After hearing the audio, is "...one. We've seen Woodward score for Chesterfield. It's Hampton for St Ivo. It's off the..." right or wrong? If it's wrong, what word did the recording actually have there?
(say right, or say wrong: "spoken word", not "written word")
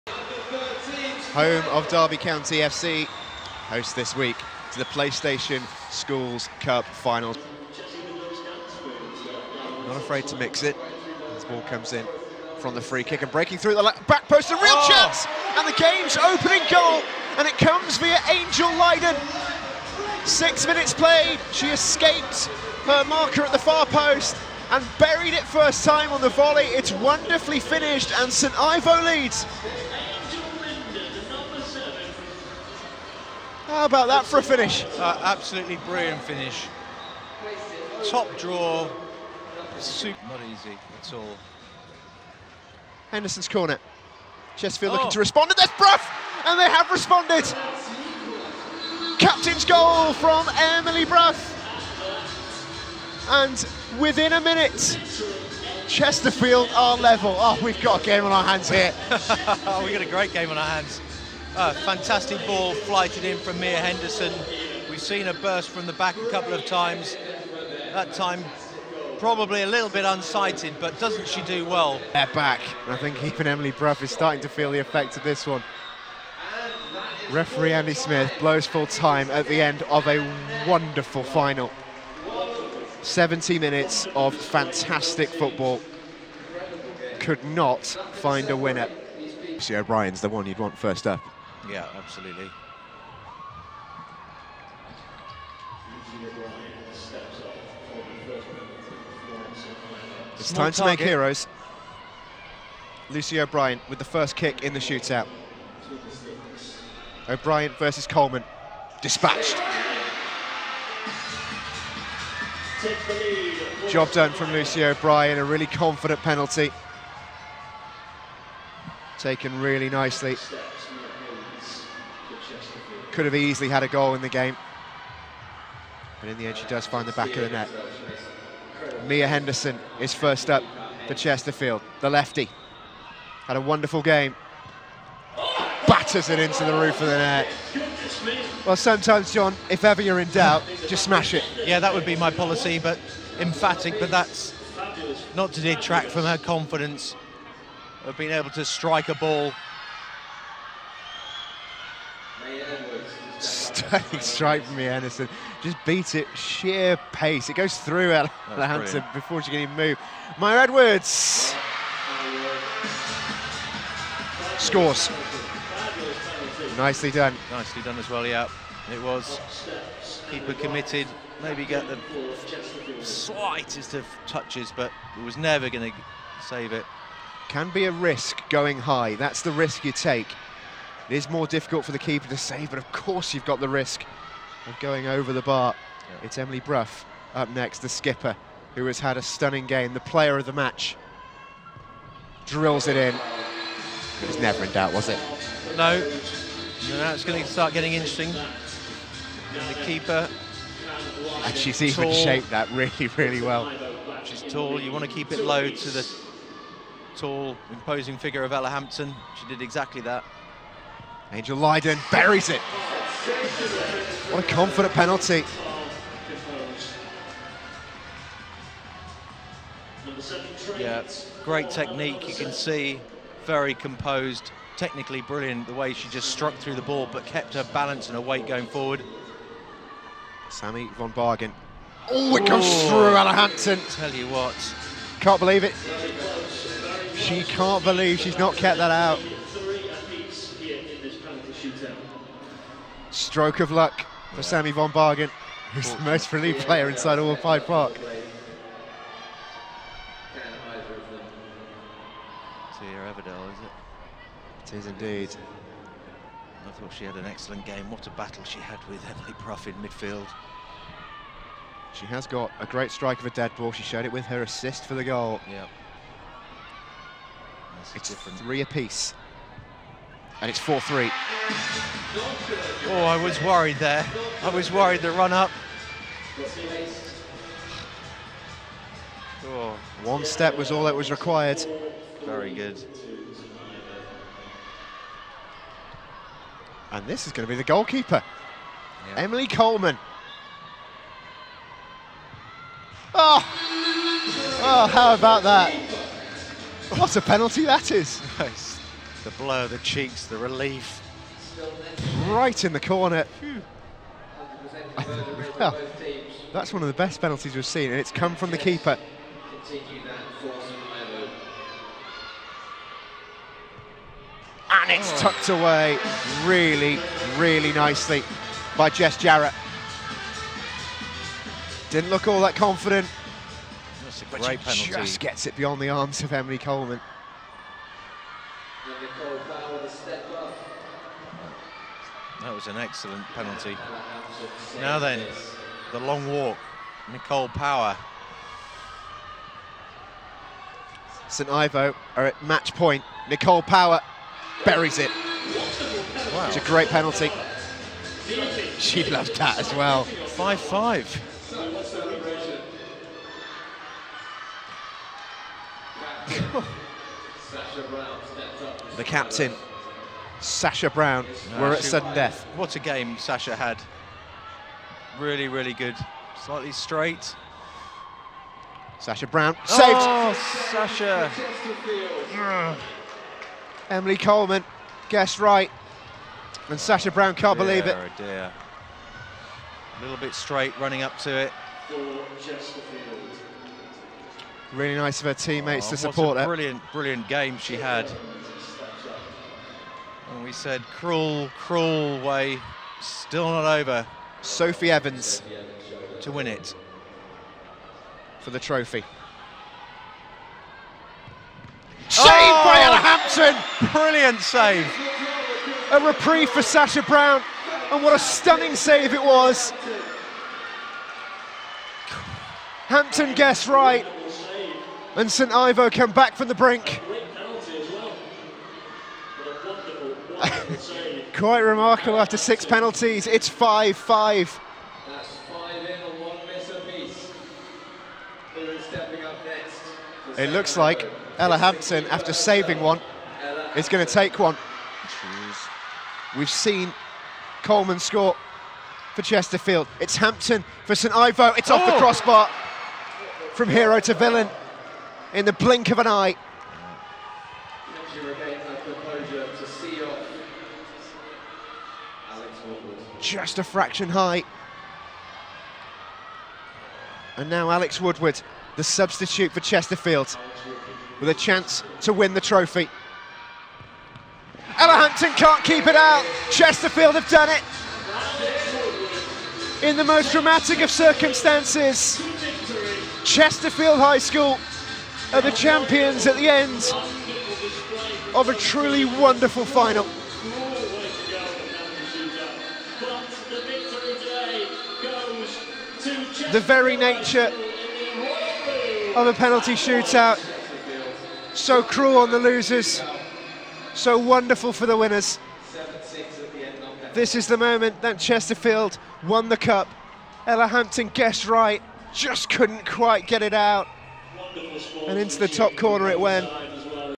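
wrong: "Coleman", not "Woodward".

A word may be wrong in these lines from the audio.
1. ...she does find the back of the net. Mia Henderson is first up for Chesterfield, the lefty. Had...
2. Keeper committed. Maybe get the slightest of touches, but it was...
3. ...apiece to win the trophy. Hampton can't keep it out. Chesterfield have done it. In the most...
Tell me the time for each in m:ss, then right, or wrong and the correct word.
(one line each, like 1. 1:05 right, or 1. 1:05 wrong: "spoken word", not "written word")
1. 2:06 right
2. 2:50 right
3. 7:41 wrong: "chance", not "apiece".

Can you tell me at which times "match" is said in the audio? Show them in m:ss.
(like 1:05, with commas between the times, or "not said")
3:10, 5:42.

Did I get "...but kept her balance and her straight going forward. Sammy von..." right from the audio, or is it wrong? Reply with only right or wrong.
wrong.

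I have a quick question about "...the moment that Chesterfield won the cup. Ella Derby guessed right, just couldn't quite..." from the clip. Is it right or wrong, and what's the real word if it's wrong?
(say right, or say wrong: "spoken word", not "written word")
wrong: "Hampton", not "Derby".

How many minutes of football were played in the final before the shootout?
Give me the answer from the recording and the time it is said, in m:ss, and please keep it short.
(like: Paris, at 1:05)
70, at 1:23.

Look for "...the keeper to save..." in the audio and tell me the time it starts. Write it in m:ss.
3:01.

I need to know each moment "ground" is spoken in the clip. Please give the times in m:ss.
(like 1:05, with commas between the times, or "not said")
not said.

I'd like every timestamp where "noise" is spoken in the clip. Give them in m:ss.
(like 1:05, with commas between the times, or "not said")
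not said.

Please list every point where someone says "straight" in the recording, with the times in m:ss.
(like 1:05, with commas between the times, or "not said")
2:34, 6:06, 6:20.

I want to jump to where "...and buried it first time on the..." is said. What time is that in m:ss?
0:24.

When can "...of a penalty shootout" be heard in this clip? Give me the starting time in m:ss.
8:09.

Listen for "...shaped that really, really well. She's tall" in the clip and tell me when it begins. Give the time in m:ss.
3:22.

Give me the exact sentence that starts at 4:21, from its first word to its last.
She has got a great strike of a dead ball.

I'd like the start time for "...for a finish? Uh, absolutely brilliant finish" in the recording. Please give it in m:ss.
0:34.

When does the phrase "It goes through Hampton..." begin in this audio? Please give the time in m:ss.
2:37.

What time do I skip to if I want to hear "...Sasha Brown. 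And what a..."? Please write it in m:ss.
6:46.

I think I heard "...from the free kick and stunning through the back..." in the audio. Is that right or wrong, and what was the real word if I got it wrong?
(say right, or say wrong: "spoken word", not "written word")
wrong: "breaking", not "stunning".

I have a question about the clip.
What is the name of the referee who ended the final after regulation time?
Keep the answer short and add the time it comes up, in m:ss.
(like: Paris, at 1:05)
Andy Smith, at 1:17.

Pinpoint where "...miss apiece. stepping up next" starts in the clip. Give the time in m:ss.
7:06.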